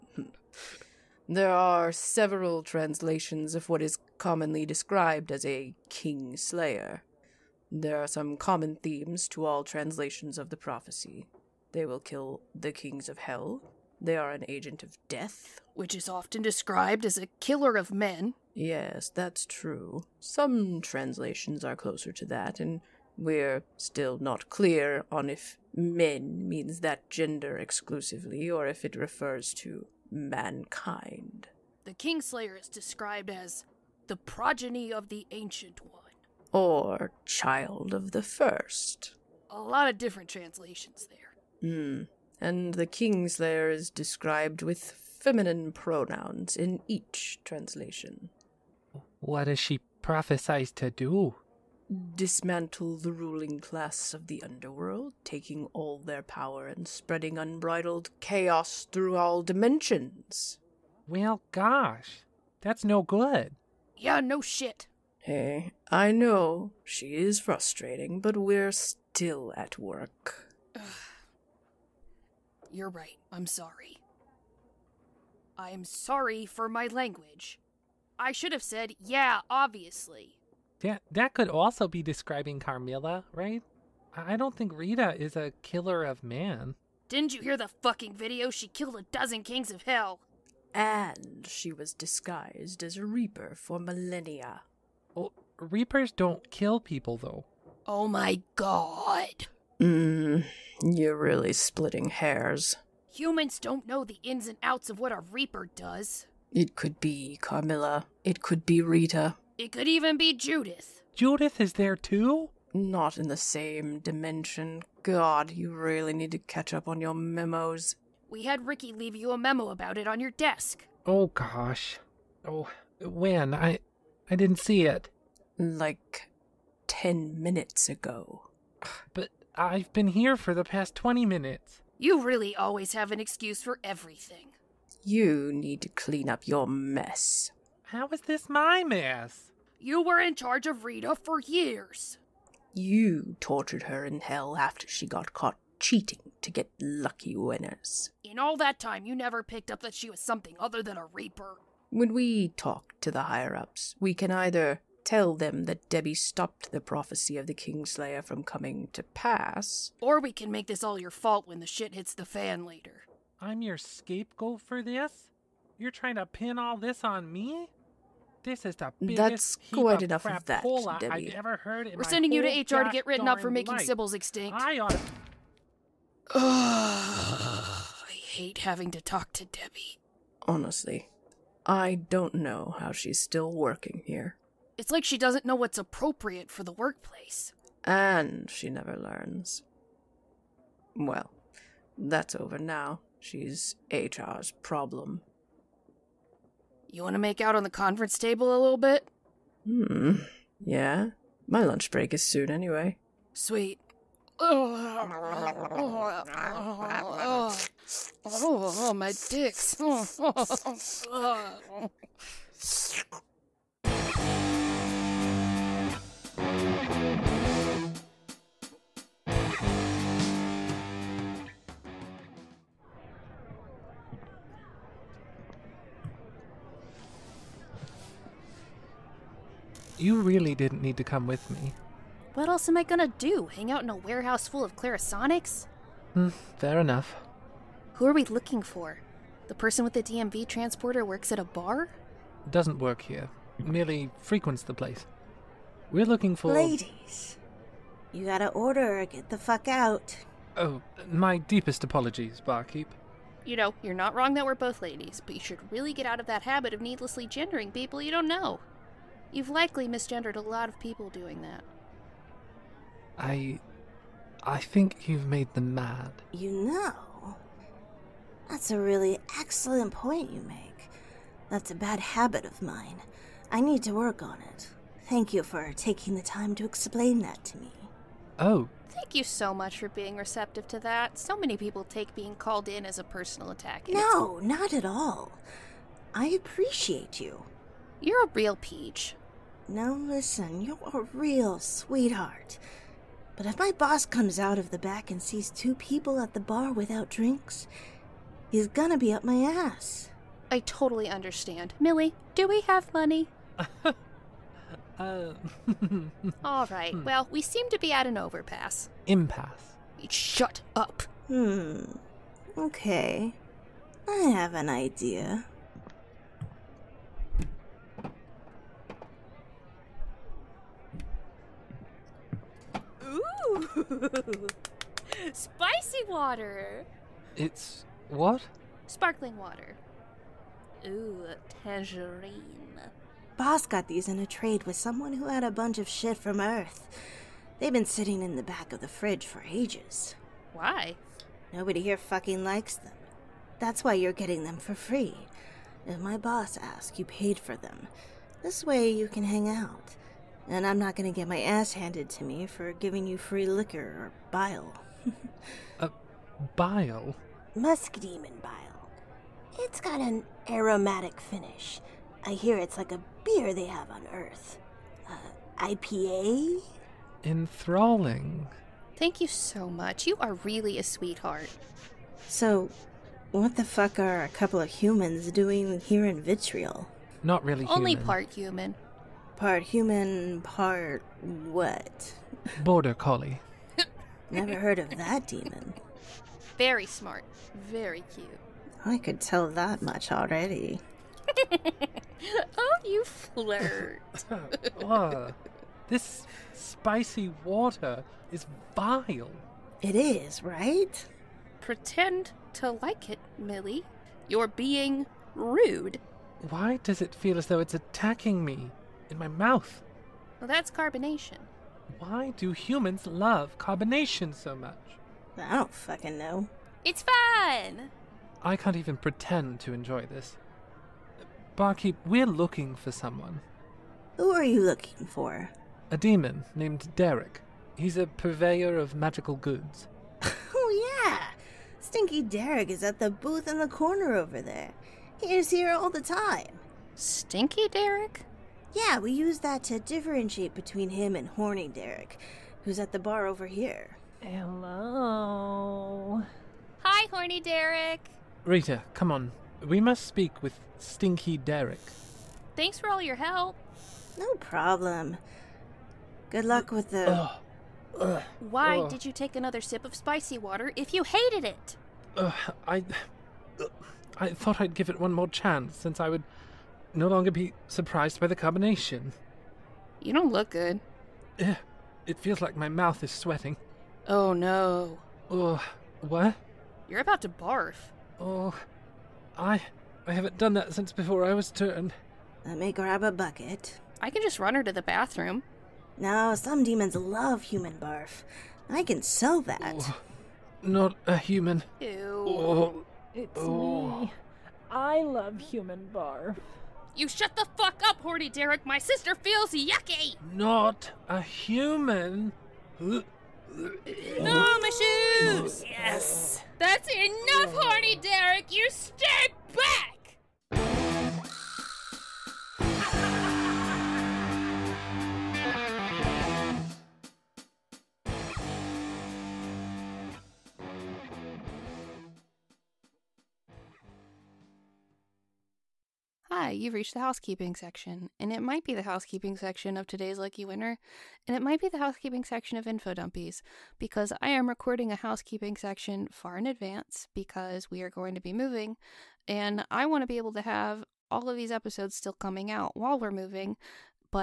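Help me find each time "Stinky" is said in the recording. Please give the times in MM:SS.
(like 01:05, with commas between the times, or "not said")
07:11, 07:16, 07:30.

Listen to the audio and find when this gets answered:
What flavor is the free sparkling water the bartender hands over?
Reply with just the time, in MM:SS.
05:31.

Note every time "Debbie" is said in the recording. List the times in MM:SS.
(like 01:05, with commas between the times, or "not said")
02:35, 02:51, 02:59.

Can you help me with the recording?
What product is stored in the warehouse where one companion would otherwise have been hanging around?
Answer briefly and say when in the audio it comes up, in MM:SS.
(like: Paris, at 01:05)
Clarisonics, at 03:54.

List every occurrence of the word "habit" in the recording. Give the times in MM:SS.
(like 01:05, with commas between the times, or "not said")
04:16, 04:32.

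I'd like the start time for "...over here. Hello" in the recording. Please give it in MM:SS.
07:23.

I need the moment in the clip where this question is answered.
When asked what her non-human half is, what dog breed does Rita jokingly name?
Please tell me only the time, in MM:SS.
06:22.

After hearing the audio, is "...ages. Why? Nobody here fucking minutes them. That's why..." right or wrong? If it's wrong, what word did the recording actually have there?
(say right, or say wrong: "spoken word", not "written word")
wrong: "likes", not "minutes".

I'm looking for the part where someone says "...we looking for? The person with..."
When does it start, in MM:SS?
03:58.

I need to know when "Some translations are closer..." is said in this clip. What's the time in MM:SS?
00:20.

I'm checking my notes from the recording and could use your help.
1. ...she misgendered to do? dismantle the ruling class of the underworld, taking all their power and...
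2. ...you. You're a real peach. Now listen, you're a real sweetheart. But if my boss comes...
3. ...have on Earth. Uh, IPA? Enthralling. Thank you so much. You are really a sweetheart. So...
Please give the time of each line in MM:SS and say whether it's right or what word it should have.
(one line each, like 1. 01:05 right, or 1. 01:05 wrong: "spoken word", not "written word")
1. 00:49 wrong: "prophesied", not "misgendered"
2. 04:47 right
3. 06:03 right.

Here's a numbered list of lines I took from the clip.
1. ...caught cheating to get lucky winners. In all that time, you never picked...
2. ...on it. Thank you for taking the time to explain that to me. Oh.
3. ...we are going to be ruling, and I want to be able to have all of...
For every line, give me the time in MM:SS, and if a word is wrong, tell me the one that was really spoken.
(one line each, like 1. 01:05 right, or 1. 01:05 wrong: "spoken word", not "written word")
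1. 02:25 right
2. 04:34 right
3. 08:57 wrong: "moving", not "ruling".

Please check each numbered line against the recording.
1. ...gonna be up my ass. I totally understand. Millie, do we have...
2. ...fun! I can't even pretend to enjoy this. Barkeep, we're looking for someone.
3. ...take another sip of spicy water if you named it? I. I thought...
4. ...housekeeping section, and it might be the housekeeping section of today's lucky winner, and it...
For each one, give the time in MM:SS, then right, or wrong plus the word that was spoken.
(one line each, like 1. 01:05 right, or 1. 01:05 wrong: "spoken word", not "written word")
1. 04:58 right
2. 06:57 right
3. 07:39 wrong: "hated", not "named"
4. 08:47 right.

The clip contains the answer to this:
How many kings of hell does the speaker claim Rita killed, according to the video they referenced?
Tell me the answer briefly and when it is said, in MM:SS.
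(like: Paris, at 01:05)
12, at 01:28.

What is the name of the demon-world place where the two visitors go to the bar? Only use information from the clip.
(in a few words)
Vitriol.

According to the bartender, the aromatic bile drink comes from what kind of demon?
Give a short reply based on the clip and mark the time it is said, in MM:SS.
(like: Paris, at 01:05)
Musk demon, at 05:57.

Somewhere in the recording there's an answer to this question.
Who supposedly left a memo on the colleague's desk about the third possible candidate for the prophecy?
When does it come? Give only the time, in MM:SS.
01:58.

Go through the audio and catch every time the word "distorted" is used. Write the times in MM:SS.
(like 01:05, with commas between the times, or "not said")
not said.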